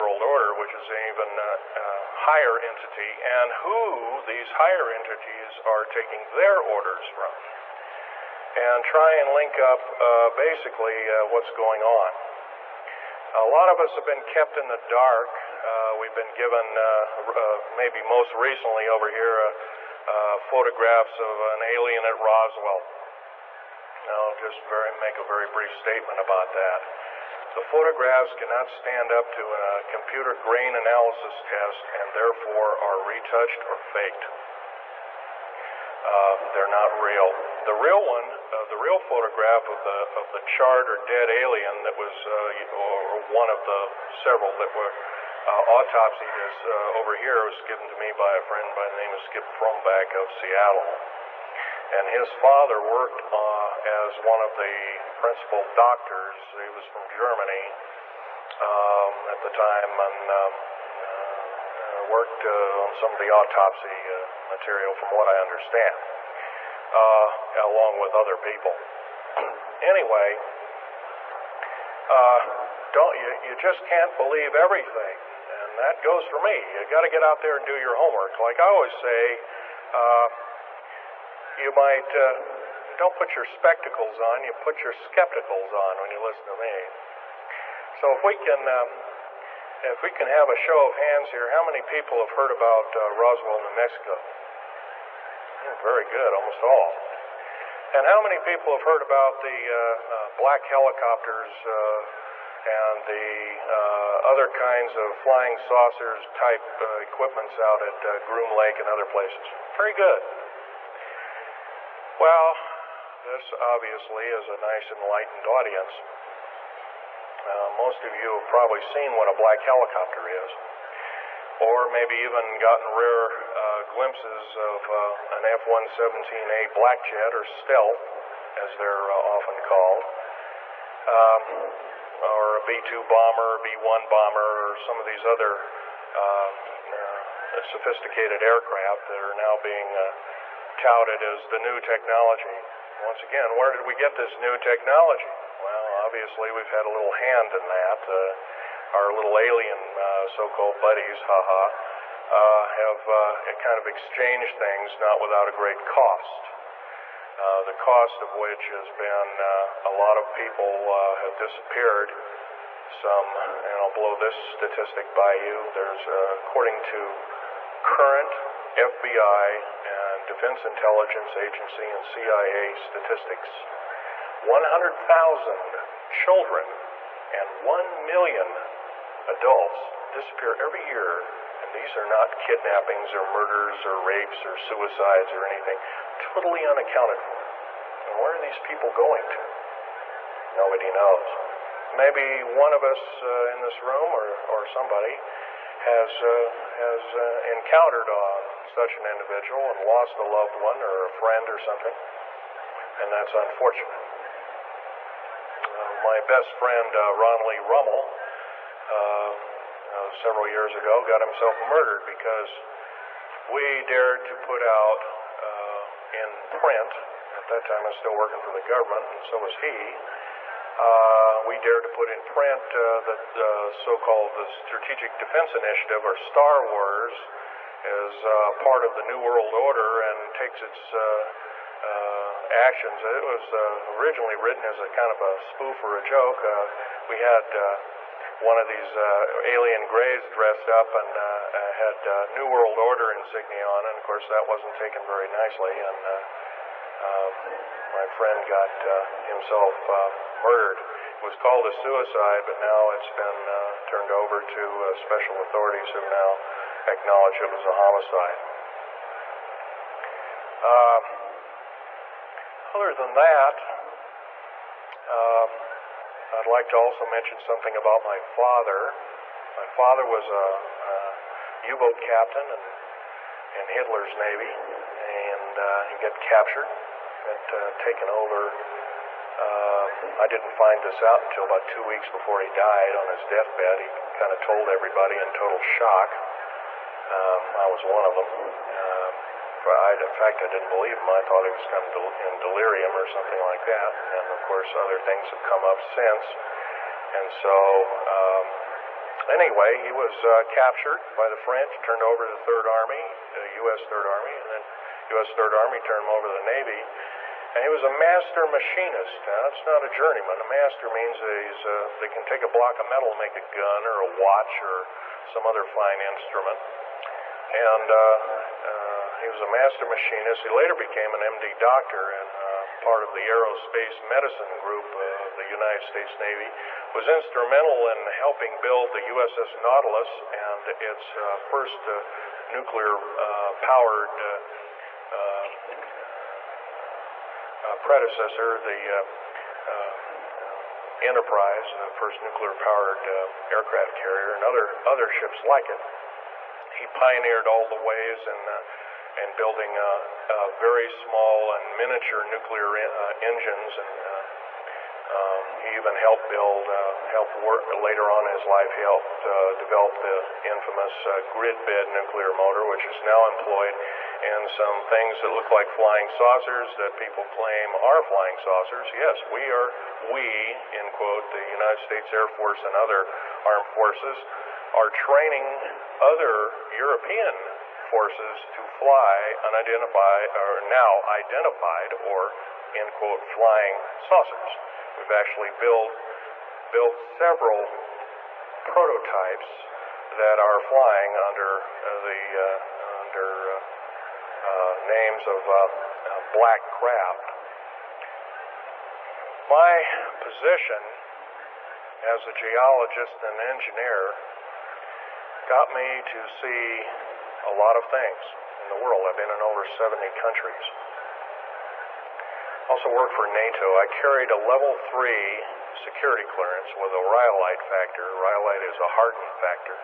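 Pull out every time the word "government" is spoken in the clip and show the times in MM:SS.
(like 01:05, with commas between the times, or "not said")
03:38.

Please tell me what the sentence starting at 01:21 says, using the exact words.
You might, uh, don't put your spectacles on, you put your skepticals on when you listen to me.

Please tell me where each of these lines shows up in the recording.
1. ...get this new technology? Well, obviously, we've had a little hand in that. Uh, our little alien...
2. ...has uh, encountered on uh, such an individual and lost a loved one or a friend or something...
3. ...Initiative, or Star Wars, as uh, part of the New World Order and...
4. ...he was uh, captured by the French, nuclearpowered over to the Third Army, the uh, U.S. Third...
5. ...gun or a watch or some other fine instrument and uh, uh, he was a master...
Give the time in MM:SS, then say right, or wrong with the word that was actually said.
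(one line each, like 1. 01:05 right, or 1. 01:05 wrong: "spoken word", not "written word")
1. 02:23 right
2. 03:16 right
3. 03:45 right
4. 04:59 wrong: "turned", not "nuclearpowered"
5. 05:13 right.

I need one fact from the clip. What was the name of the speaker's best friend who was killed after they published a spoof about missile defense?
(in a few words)
Ron Lee Rummel.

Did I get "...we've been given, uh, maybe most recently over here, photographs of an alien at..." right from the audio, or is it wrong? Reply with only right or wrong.
right.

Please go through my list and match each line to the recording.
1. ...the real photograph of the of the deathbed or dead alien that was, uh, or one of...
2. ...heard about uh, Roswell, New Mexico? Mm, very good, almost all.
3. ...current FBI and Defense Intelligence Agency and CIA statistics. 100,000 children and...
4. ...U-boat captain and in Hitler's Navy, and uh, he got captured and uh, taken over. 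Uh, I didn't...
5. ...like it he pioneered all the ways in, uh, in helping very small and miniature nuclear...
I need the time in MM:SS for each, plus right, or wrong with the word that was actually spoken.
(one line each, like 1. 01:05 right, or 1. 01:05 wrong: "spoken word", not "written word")
1. 00:38 wrong: "charred", not "deathbed"
2. 01:32 right
3. 02:47 right
4. 04:31 right
5. 05:45 wrong: "building", not "helping".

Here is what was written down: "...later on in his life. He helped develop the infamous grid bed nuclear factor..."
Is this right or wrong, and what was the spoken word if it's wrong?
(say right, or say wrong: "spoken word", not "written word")
wrong: "motor", not "factor".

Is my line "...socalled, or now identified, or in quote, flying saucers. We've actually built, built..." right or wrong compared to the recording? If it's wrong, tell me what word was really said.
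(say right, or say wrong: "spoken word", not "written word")
wrong: "unidentified", not "socalled".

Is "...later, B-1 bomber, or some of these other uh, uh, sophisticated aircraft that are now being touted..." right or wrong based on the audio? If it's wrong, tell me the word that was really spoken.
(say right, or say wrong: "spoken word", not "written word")
wrong: "bomber", not "later".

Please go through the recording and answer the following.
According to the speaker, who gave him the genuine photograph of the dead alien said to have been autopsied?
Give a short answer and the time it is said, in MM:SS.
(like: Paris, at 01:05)
Skip Fromback, at 00:49.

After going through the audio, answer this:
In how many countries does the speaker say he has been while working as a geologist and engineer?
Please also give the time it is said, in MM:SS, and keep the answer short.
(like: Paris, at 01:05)
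70, at 06:49.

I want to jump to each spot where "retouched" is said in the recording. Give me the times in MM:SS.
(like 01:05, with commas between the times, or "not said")
00:33.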